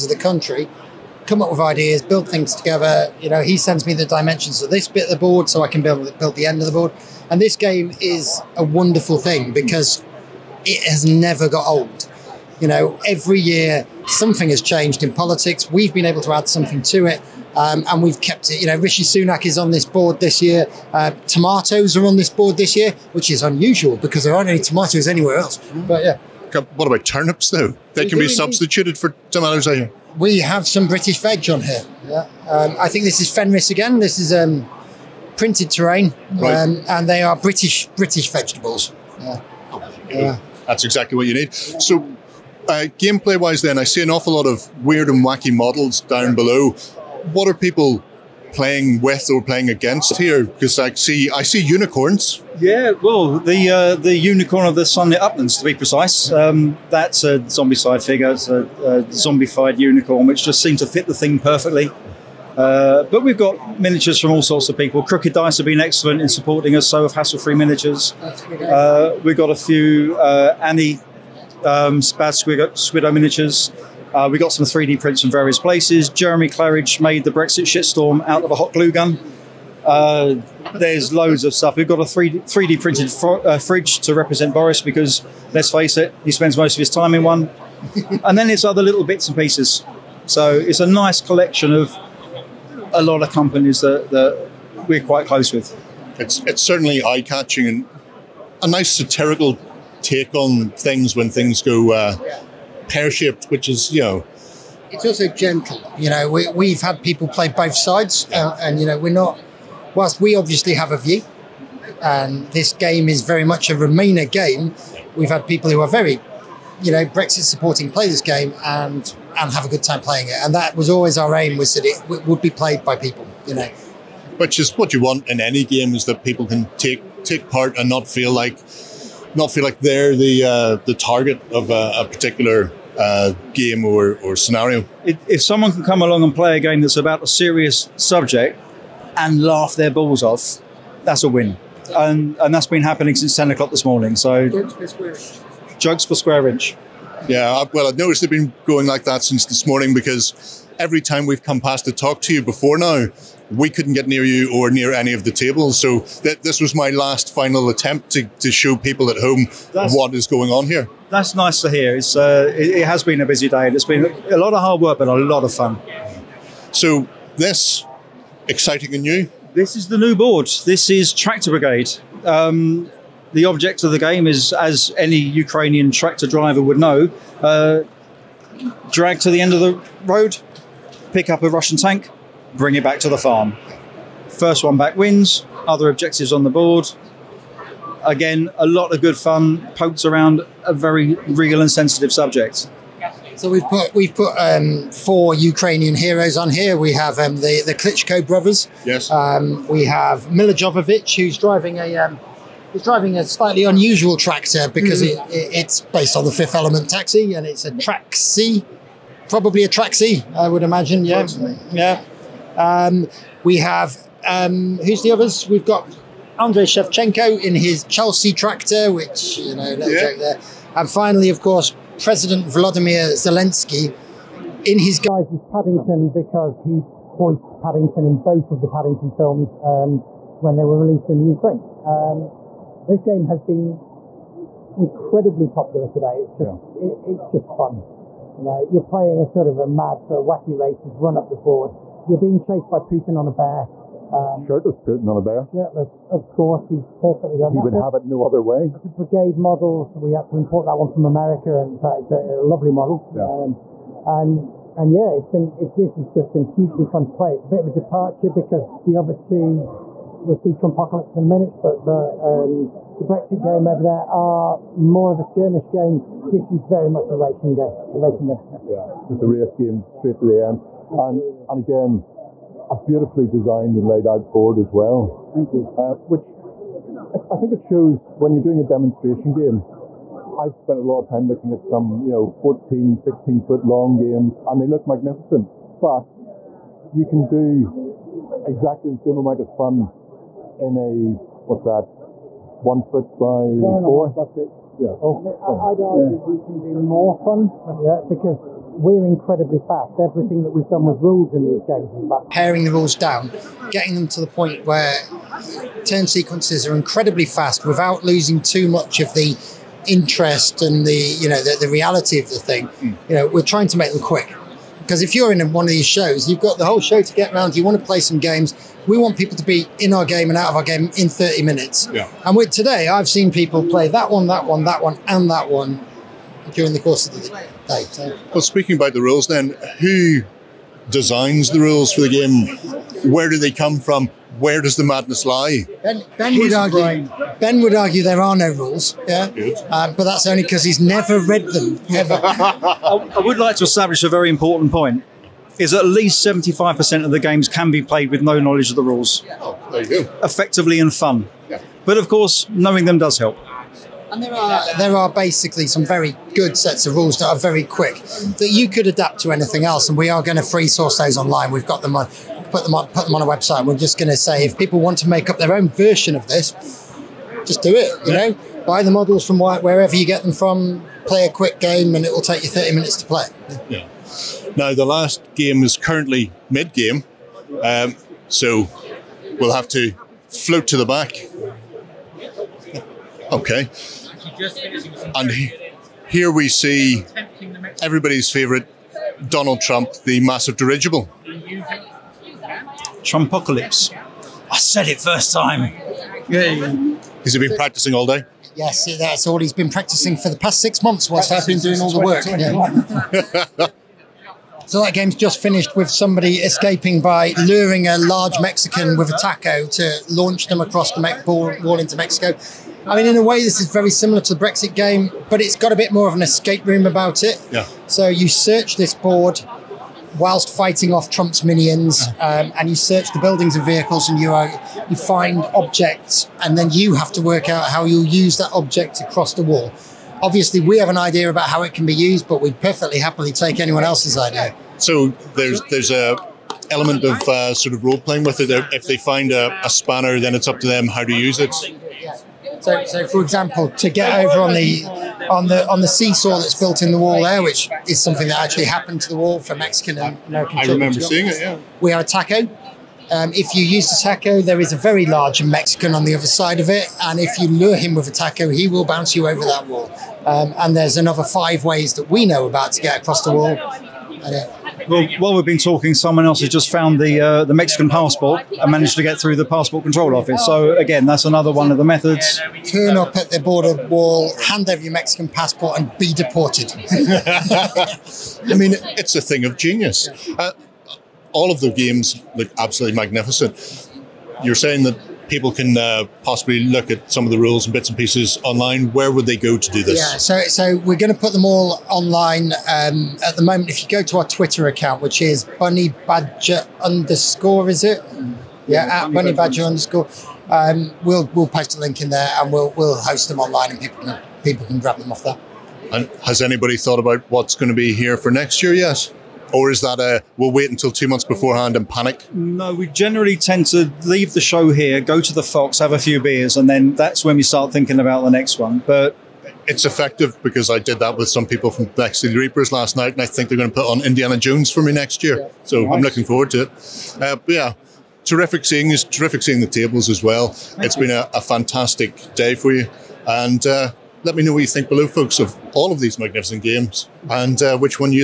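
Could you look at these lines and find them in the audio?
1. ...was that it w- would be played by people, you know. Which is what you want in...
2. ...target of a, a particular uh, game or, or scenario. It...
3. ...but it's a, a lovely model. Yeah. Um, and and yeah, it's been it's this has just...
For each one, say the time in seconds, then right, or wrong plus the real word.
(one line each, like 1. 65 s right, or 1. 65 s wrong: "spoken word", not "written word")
1. 121 s right
2. 130 s right
3. 251 s right.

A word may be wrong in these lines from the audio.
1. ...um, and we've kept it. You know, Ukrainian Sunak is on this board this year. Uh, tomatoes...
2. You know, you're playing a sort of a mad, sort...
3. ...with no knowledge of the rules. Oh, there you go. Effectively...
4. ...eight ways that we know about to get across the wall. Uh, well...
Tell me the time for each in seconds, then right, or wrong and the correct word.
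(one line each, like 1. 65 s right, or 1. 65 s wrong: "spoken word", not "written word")
1. 17 s wrong: "Rishi", not "Ukrainian"
2. 238 s right
3. 348 s right
4. 461 s wrong: "five", not "eight".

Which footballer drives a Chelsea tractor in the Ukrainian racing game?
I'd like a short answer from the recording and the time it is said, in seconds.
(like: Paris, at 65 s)
Andrei Shevchenko, at 216 s.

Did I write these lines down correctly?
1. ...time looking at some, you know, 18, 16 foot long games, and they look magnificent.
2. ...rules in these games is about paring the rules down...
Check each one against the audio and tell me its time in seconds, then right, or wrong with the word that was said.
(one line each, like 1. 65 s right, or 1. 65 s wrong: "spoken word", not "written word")
1. 281 s wrong: "14", not "18"
2. 301 s right.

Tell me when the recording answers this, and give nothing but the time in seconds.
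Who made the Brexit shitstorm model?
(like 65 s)
76 s.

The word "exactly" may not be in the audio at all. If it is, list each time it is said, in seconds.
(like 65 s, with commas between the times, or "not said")
40 s, 288 s.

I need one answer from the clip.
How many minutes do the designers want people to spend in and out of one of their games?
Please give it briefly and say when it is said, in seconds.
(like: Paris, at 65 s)
30, at 321 s.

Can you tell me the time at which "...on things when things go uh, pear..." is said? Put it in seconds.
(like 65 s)
100 s.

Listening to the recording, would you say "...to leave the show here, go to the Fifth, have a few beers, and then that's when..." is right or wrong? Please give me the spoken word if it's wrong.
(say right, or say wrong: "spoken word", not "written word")
wrong: "Fox", not "Fifth".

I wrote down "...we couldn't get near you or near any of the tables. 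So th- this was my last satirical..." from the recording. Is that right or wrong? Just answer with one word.
wrong.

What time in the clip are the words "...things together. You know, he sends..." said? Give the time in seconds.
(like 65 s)
2 s.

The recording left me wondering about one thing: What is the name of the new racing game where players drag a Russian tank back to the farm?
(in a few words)
Tractor Brigade.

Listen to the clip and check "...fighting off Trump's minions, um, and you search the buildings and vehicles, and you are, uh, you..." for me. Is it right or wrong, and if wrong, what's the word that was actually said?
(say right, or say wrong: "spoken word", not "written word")
right.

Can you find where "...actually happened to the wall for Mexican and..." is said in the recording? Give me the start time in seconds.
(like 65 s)
448 s.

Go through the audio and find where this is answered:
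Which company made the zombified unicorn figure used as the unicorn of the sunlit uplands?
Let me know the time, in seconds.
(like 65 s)
57 s.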